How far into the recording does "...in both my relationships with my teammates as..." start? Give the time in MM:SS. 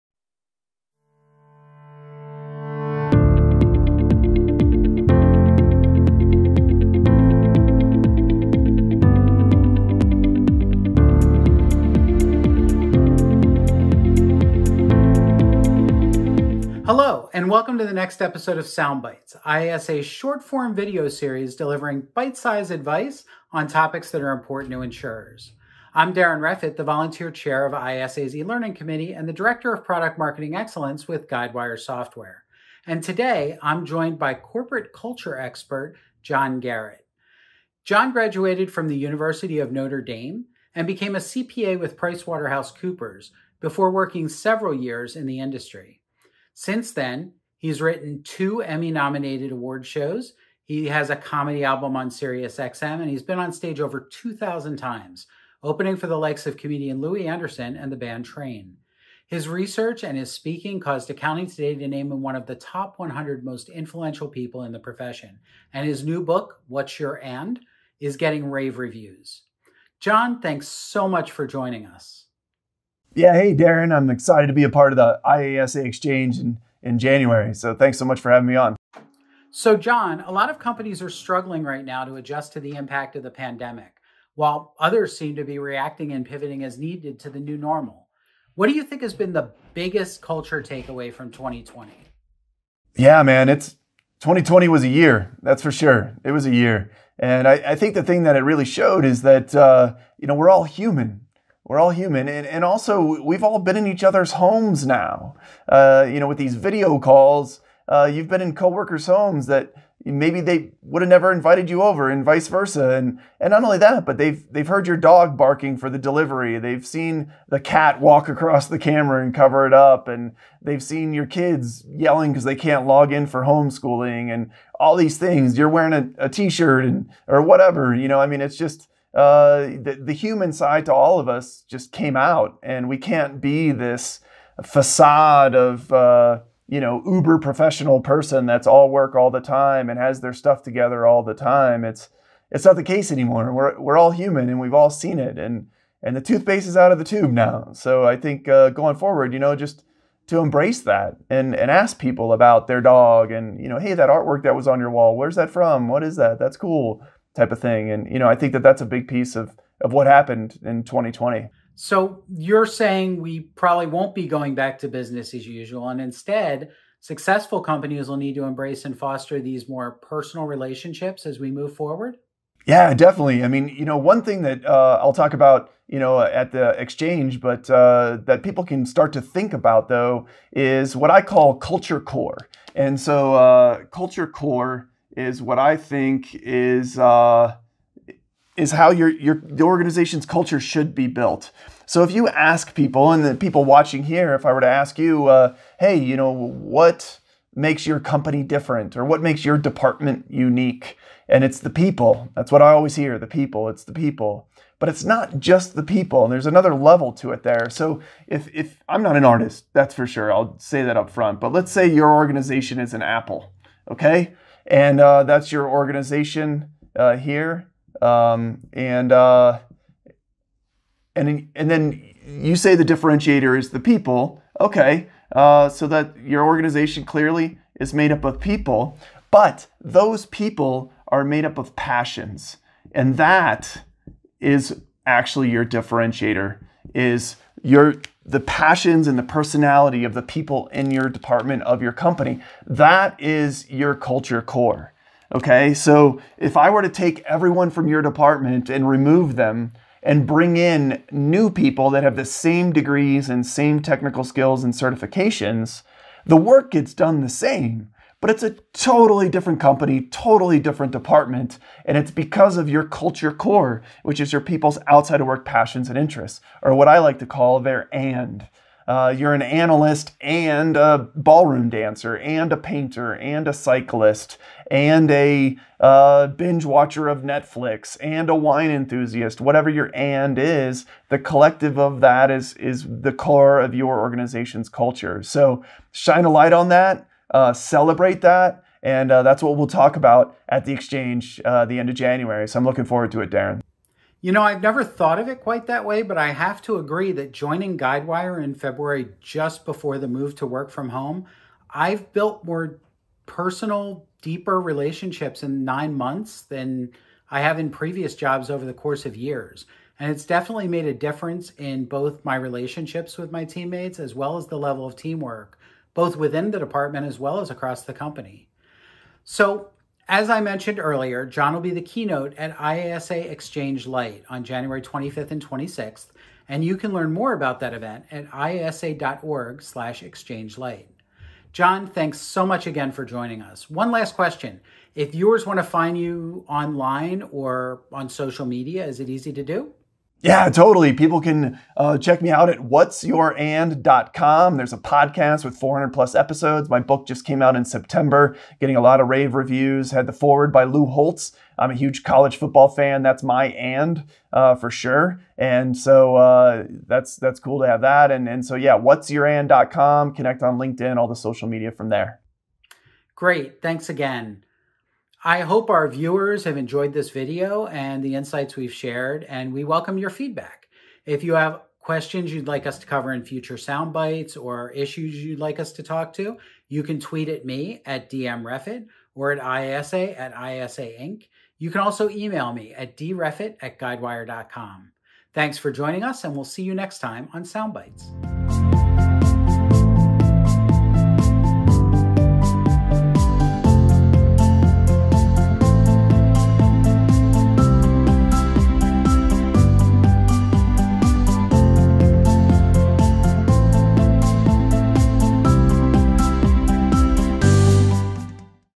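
05:11.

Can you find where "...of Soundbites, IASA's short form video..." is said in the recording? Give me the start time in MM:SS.
00:18.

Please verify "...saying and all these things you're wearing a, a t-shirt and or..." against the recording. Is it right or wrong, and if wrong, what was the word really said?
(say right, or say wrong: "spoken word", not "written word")
wrong: "homeschooling", not "saying".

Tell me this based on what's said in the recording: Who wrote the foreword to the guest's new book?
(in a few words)
Lou Holtz.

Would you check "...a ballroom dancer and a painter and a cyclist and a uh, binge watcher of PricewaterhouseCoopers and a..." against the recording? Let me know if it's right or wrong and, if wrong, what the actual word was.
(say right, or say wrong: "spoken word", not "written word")
wrong: "Netflix", not "PricewaterhouseCoopers".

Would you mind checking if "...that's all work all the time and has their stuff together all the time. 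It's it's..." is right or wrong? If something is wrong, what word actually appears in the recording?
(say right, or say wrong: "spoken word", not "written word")
right.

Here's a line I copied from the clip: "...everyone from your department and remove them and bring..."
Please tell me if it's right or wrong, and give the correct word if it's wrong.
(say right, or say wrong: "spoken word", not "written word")
right.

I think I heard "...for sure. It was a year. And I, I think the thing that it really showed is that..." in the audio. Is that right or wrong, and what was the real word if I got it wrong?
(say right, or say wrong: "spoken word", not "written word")
right.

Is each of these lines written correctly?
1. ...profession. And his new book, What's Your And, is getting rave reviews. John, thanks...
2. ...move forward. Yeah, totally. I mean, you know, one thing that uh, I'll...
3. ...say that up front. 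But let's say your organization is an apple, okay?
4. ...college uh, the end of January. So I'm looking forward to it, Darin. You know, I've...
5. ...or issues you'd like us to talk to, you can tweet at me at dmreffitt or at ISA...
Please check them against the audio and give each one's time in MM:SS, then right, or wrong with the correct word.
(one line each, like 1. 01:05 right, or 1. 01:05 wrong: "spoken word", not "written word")
1. 01:04 right
2. 02:51 wrong: "definitely", not "totally"
3. 03:30 right
4. 04:50 wrong: "exchange", not "college"
5. 06:14 right.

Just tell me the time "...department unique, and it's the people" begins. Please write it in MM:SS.
03:19.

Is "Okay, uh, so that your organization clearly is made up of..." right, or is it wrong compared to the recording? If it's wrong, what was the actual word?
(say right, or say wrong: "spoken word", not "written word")
right.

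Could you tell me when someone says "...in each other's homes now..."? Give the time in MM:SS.
01:43.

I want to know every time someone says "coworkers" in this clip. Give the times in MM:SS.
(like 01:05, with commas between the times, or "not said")
01:48.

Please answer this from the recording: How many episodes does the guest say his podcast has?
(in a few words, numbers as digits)
400 plus.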